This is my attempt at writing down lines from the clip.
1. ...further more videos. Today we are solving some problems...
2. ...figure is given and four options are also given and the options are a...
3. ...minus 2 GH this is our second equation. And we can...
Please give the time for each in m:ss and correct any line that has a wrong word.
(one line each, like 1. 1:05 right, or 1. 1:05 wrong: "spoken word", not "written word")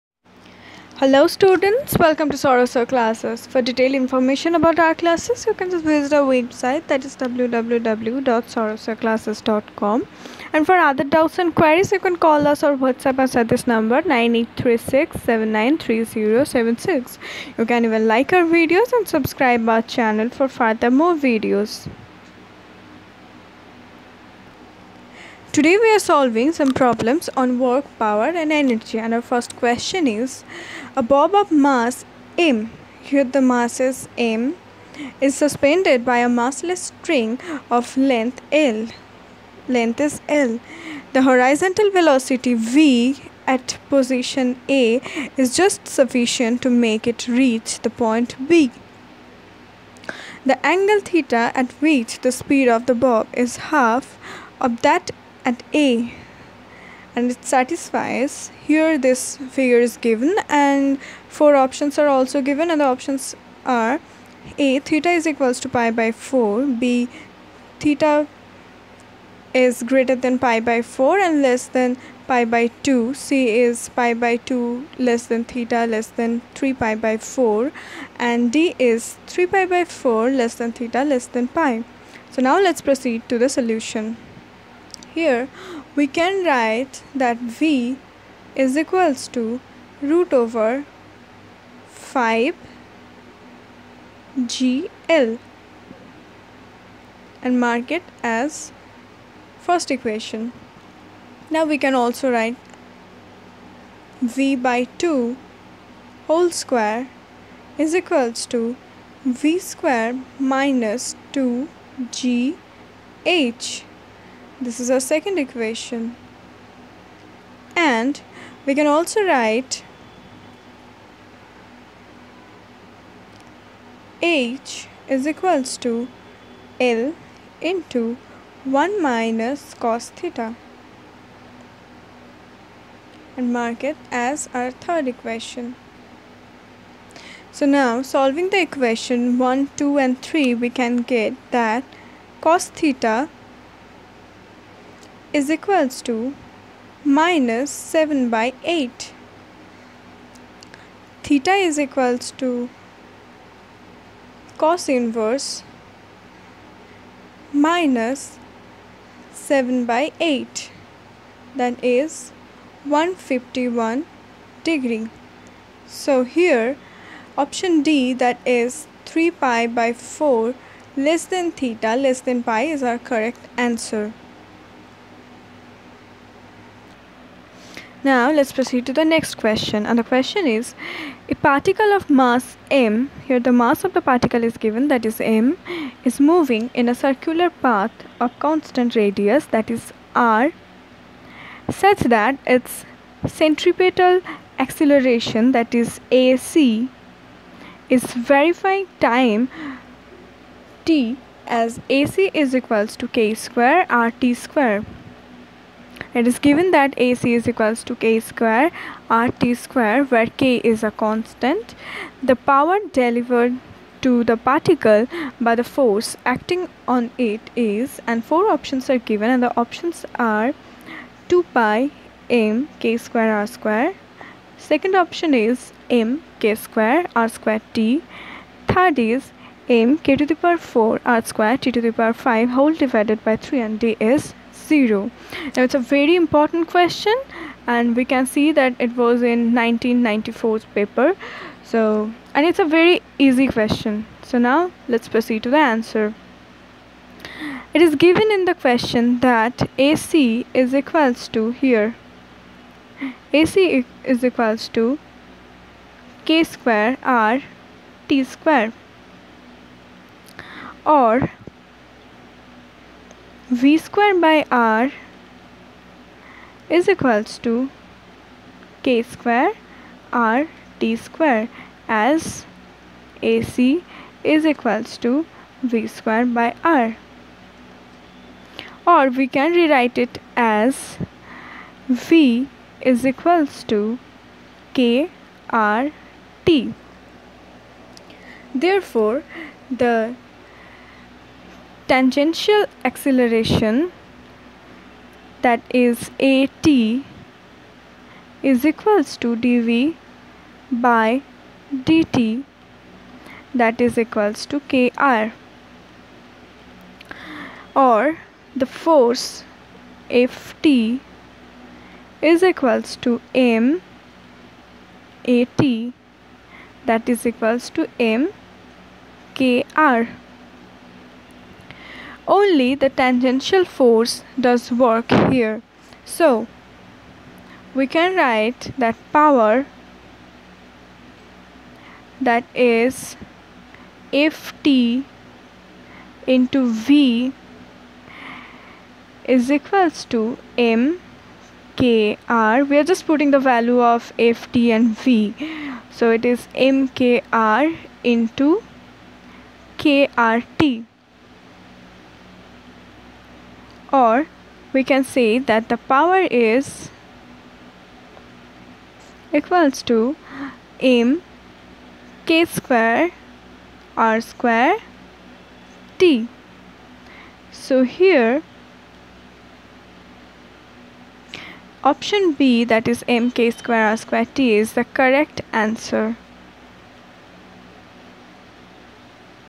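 1. 0:20 right
2. 0:59 right
3. 1:50 right.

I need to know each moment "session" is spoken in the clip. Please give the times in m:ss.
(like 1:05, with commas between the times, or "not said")
not said.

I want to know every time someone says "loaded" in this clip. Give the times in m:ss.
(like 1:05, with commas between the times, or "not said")
not said.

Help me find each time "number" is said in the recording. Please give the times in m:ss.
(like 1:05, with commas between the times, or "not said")
0:13.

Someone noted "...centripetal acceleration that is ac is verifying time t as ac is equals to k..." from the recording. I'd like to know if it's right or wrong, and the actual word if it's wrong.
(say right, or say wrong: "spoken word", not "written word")
right.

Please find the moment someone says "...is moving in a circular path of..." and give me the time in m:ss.
3:06.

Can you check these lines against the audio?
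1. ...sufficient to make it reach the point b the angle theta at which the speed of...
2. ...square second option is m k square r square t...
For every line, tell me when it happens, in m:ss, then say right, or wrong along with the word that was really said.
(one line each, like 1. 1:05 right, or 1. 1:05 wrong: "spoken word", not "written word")
1. 0:45 right
2. 3:43 right.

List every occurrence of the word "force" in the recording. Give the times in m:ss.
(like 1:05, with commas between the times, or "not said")
3:35, 5:08, 5:23.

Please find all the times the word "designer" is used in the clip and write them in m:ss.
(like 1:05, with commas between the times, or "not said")
not said.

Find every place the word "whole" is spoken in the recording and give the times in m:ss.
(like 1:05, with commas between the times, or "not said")
1:46, 3:52.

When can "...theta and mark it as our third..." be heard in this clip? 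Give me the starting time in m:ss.
2:10.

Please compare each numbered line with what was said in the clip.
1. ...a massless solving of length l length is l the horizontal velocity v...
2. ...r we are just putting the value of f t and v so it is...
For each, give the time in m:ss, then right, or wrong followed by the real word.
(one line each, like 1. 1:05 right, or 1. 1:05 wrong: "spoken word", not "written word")
1. 0:36 wrong: "string", not "solving"
2. 5:42 right.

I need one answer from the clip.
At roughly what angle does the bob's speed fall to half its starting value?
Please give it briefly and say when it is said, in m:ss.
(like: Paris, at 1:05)
151 degrees, at 2:42.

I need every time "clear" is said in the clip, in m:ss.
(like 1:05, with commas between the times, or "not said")
not said.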